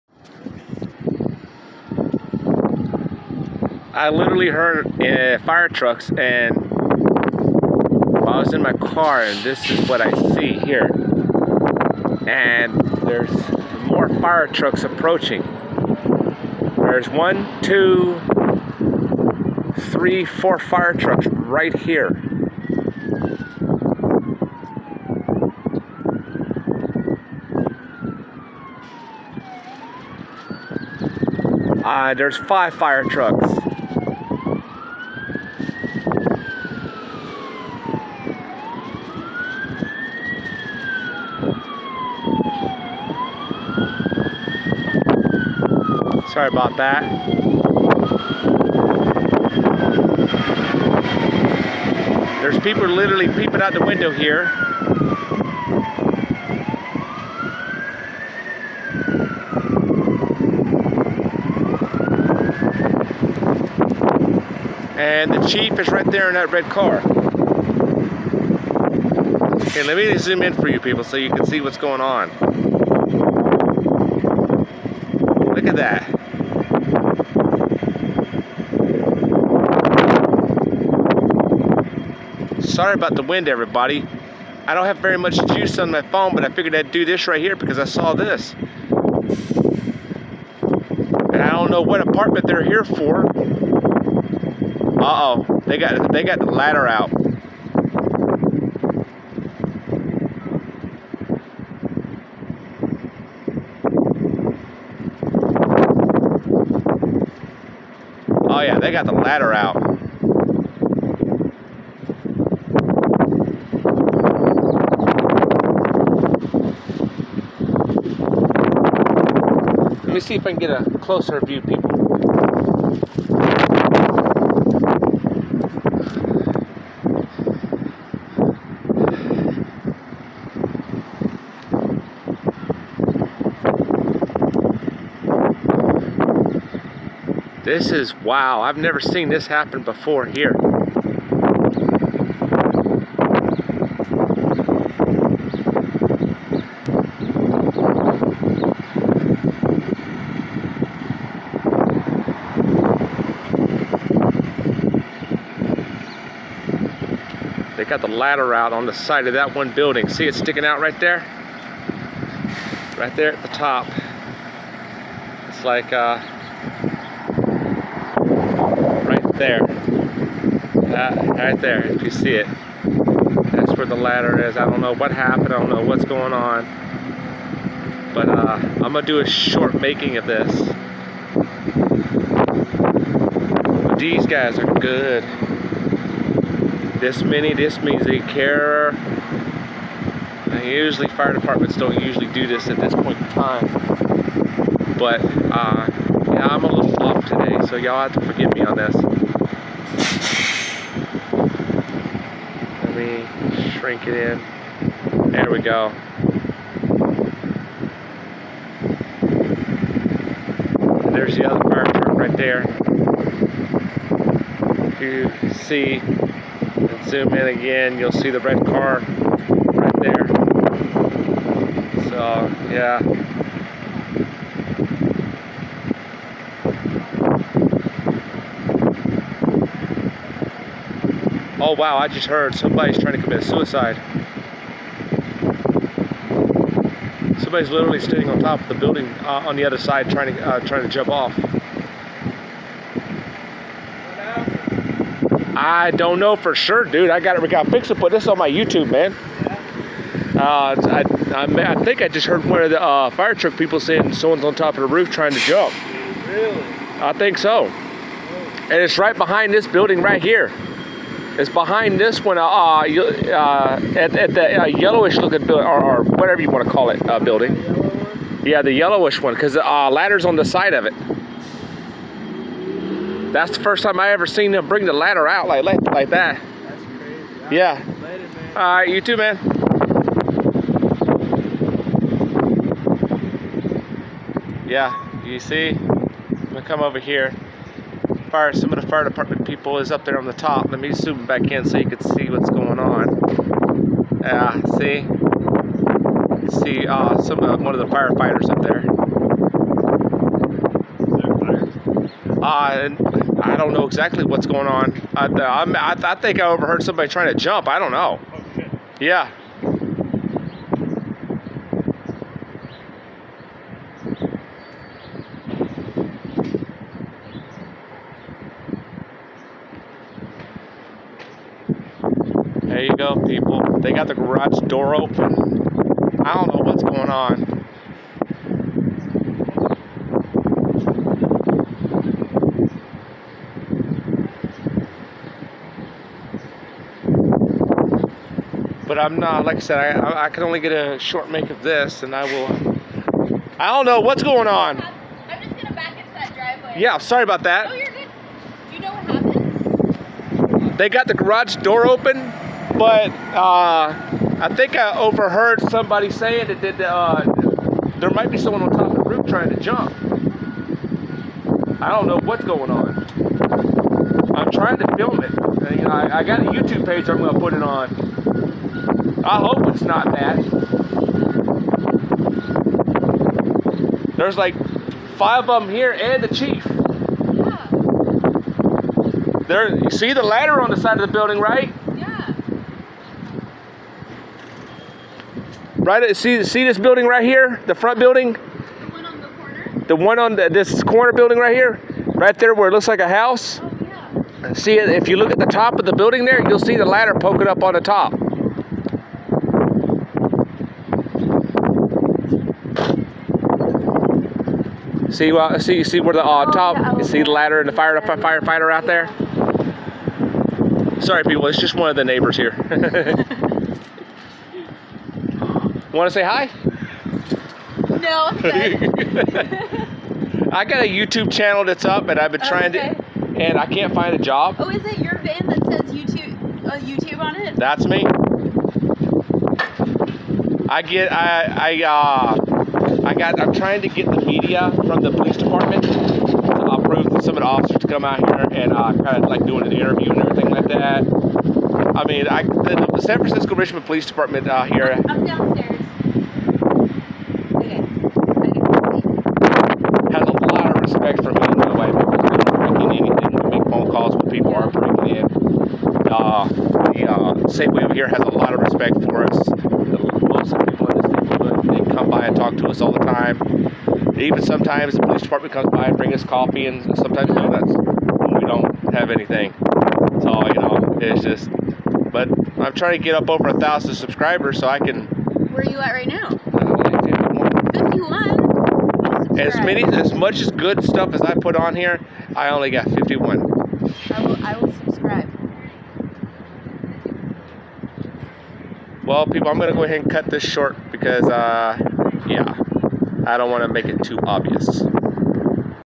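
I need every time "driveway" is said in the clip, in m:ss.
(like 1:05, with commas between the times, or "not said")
5:46.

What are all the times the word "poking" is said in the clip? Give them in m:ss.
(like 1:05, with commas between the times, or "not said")
6:37.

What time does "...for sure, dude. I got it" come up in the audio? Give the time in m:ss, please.
4:06.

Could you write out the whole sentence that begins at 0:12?
And there's more fire trucks approaching.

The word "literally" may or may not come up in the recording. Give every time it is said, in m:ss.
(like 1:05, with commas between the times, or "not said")
0:04, 0:52, 3:57.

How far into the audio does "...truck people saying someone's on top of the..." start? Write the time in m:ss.
4:13.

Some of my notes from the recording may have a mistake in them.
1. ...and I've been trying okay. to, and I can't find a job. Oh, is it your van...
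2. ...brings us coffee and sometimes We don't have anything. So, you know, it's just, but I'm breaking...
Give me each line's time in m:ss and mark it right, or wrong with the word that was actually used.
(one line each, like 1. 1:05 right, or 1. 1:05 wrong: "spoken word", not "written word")
1. 7:02 right
2. 7:45 wrong: "trying", not "breaking".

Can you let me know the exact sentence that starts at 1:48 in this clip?
Oh yeah, they got the ladder out.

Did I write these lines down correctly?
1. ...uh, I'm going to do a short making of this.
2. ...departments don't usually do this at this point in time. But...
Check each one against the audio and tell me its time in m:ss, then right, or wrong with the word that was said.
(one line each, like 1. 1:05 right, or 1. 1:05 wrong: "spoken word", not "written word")
1. 2:58 right
2. 3:11 right.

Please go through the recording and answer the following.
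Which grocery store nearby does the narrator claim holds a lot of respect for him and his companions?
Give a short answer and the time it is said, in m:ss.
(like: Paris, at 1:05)
Safeway, at 7:37.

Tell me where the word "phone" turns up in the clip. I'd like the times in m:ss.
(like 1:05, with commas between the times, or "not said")
1:26, 7:33.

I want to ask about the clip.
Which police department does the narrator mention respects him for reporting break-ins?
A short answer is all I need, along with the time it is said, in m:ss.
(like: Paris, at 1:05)
San Francisco Richmond Police Department, at 7:23.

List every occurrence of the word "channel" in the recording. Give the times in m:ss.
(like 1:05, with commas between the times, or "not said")
7:01.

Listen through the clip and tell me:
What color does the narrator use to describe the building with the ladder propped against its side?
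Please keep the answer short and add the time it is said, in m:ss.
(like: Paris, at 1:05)
yellowish, at 4:24.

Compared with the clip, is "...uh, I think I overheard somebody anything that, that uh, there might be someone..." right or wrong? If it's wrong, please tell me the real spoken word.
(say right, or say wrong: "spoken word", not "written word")
wrong: "saying", not "anything".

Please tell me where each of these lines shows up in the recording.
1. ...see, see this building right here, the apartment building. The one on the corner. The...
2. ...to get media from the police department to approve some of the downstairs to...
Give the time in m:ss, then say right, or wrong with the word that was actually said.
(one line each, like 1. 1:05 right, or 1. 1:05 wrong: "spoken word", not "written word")
1. 6:26 wrong: "front", not "apartment"
2. 7:13 wrong: "officers", not "downstairs".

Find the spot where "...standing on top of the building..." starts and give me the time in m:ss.
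3:57.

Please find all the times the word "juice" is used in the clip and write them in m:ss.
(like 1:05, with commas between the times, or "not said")
1:25.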